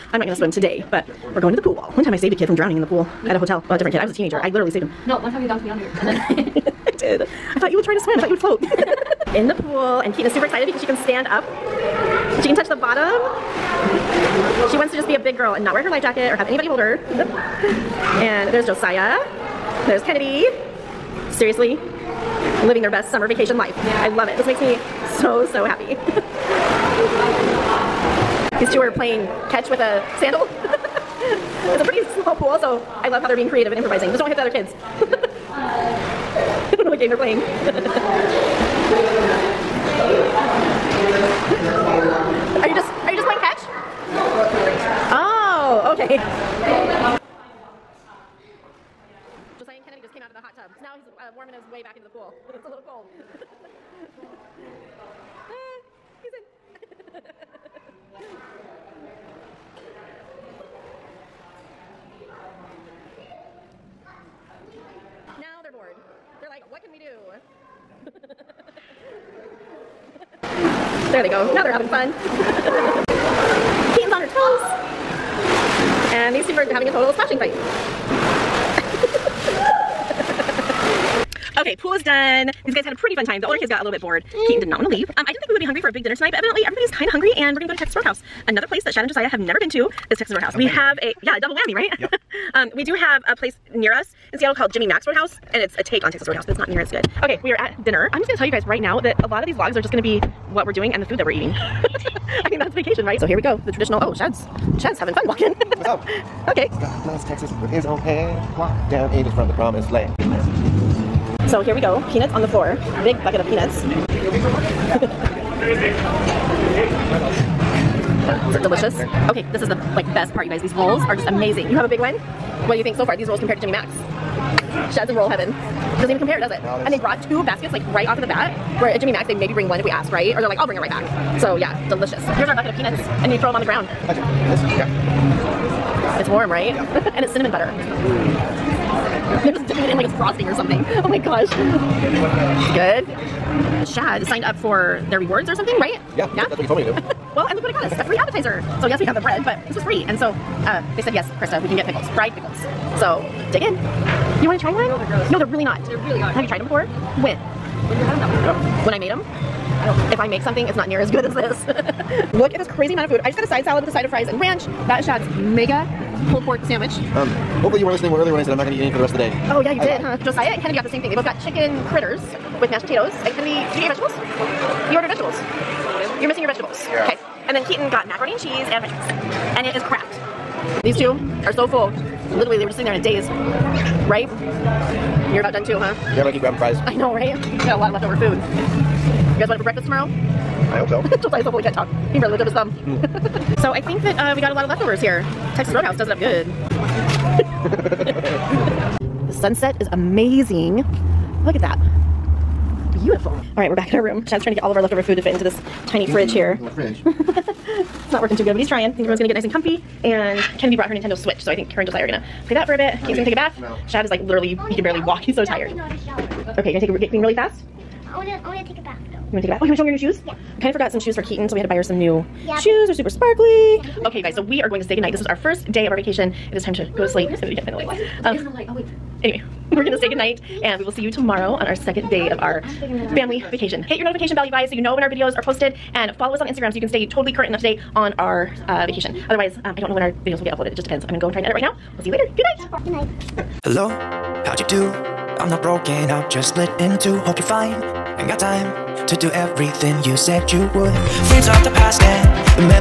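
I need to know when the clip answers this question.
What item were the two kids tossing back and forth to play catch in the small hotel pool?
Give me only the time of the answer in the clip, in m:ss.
0:30.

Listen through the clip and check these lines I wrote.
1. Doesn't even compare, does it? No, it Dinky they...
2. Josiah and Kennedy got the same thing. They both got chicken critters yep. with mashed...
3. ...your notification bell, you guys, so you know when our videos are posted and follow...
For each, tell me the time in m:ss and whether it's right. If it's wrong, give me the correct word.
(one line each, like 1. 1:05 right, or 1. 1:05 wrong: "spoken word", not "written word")
1. 2:05 wrong: "And", not "Dinky"
2. 2:50 right
3. 3:53 right.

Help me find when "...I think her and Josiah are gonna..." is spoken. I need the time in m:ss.
3:31.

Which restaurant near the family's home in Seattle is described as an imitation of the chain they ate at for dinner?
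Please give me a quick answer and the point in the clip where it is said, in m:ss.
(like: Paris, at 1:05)
Jimmy Mac's Roadhouse, at 1:34.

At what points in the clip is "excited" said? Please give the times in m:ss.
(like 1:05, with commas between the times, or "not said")
0:10.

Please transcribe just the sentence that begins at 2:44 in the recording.
That is Shad's mega pulled pork sandwich.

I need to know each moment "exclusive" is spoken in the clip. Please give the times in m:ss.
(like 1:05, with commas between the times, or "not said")
not said.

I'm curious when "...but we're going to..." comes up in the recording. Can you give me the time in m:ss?
0:00.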